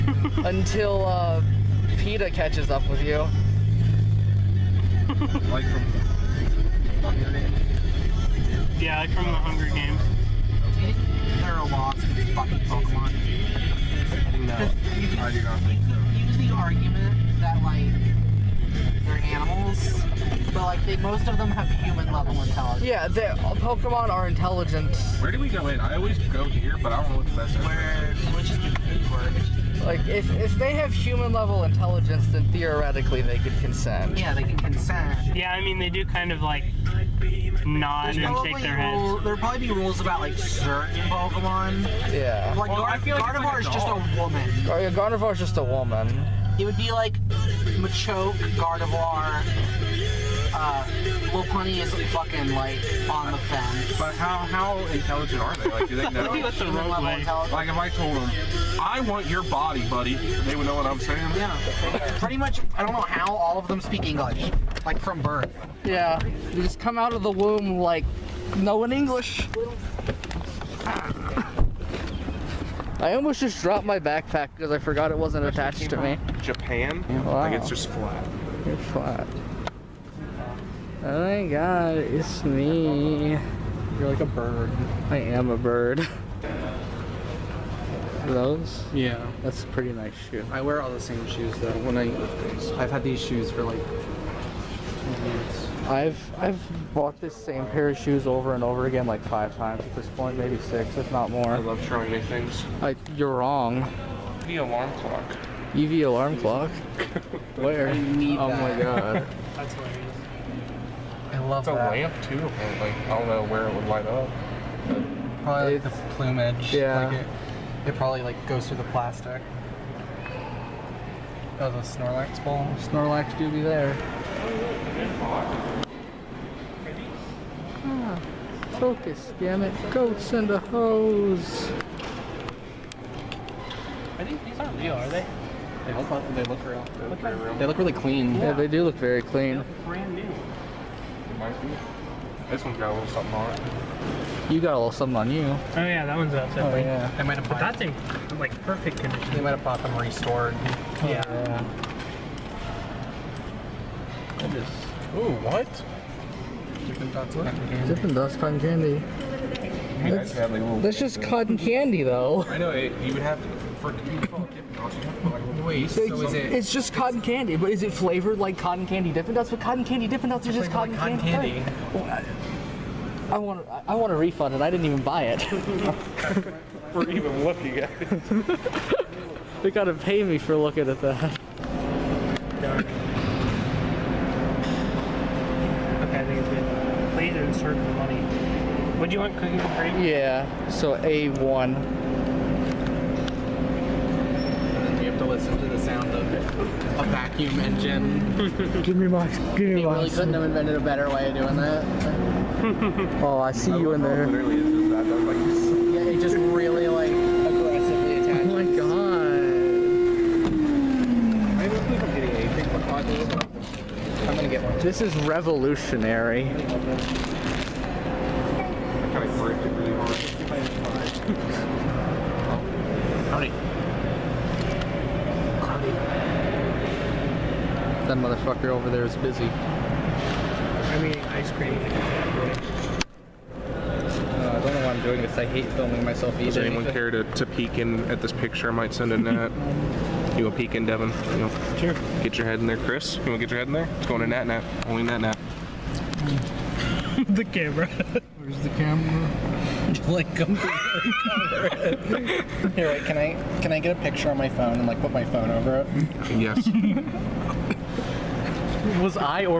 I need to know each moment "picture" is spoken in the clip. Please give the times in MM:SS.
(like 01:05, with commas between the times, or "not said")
03:58, 04:13.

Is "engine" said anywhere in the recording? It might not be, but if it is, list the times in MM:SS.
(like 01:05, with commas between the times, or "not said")
03:17.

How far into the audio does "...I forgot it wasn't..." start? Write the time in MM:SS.
01:14.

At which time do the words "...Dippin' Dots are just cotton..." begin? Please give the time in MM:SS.
02:50.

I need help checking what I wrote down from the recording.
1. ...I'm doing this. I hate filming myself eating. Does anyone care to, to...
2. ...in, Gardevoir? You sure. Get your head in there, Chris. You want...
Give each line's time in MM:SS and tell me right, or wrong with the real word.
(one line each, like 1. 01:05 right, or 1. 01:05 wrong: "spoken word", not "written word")
1. 03:54 right
2. 04:00 wrong: "Devin", not "Gardevoir".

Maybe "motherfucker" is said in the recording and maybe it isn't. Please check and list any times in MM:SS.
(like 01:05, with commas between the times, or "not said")
03:48.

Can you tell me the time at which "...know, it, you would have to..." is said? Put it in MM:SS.
02:42.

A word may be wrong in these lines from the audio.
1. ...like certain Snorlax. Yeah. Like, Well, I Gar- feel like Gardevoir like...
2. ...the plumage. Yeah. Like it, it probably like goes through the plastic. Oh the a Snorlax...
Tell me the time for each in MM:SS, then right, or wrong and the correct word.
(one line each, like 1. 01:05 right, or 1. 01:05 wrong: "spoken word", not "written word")
1. 00:40 wrong: "Pokemon", not "Snorlax"
2. 01:55 right.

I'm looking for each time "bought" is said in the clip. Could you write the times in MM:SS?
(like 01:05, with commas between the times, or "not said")
01:36, 02:29.